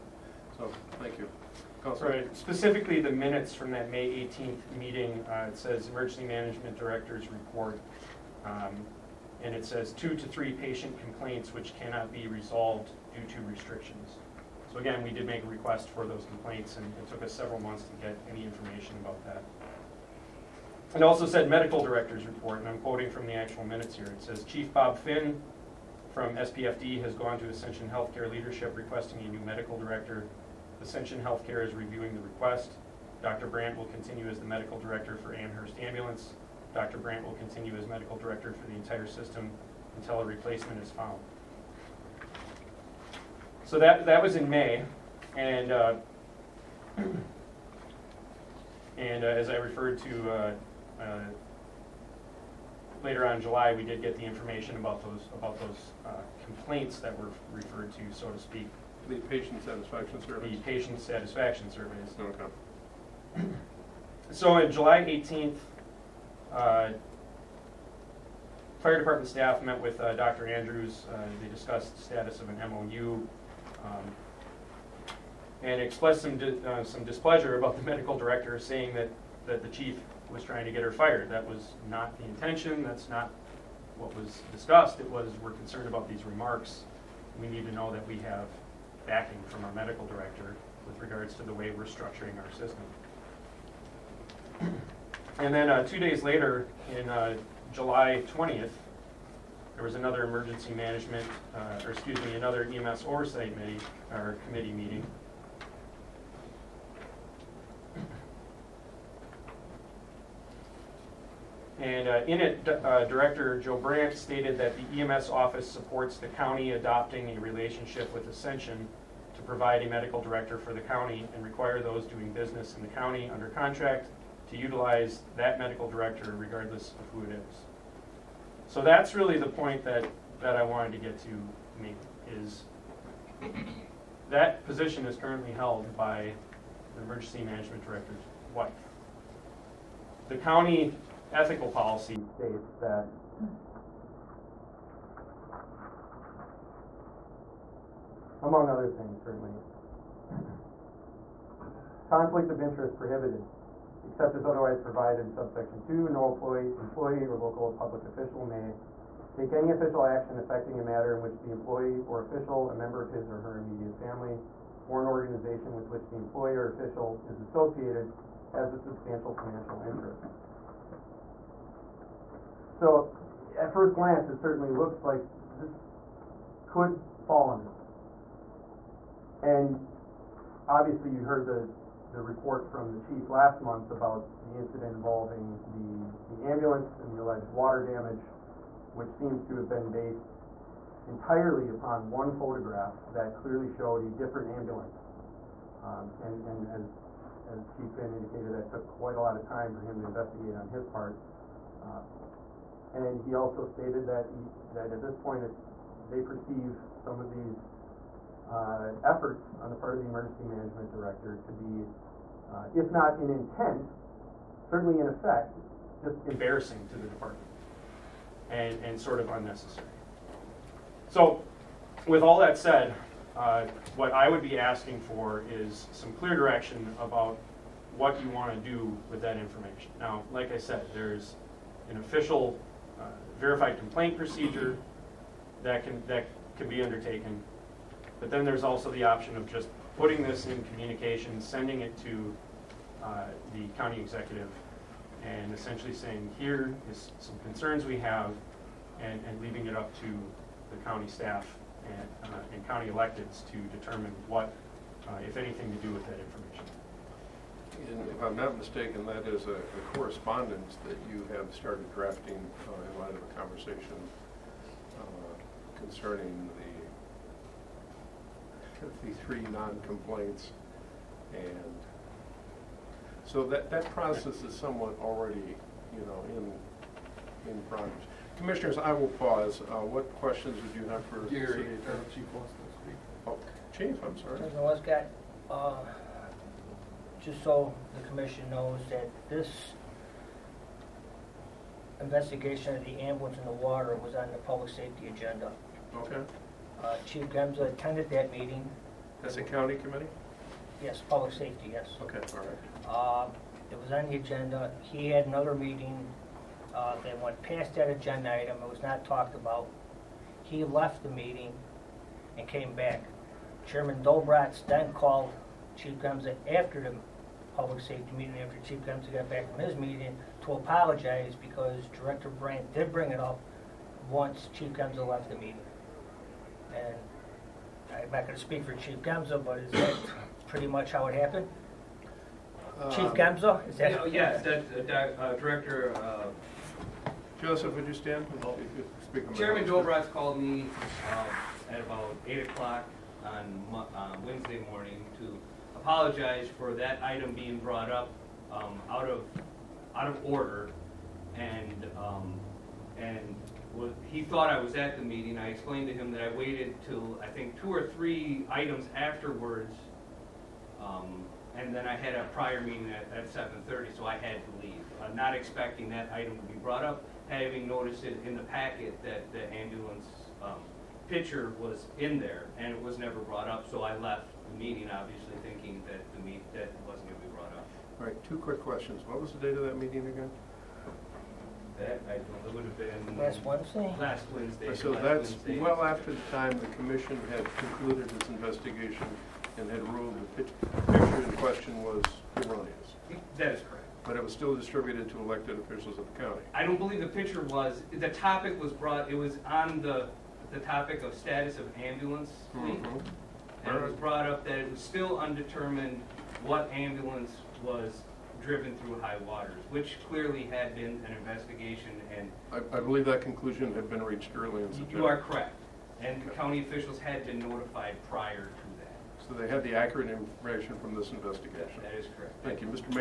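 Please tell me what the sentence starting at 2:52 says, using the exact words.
So at first glance, it certainly looks like this could fall under.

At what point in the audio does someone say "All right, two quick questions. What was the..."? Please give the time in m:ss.
6:17.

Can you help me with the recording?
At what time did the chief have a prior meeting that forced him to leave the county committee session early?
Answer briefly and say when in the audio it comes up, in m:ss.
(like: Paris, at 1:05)
7:30, at 6:03.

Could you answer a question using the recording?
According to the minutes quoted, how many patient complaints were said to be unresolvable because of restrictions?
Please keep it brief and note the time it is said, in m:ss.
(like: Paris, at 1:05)
2 to 3, at 0:09.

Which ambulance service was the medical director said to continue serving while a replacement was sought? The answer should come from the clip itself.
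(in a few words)
Amherst Ambulance.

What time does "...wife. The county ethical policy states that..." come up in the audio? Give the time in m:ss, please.
2:18.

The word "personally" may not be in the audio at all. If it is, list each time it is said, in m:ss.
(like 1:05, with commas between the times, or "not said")
not said.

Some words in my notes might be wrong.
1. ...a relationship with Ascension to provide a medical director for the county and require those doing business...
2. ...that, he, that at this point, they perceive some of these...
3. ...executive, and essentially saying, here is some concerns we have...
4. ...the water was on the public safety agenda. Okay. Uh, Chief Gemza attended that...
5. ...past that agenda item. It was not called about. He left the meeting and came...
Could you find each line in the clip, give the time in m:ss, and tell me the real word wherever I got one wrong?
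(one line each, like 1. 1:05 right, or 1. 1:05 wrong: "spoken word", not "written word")
1. 1:57 right
2. 3:24 right
3. 4:03 right
4. 4:53 right
5. 5:07 wrong: "talked", not "called".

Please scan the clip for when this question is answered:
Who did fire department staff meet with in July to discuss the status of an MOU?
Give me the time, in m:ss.
1:10.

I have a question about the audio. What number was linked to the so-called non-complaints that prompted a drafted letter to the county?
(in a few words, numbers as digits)
53.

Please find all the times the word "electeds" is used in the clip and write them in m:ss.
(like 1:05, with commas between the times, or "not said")
4:12, 6:35.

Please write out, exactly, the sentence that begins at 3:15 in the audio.
Um, and, and as, as Chief Finn indicated, that took quite a lot of time for him to investigate on his part.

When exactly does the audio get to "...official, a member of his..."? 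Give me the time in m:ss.
2:42.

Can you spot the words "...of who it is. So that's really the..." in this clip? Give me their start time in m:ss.
2:06.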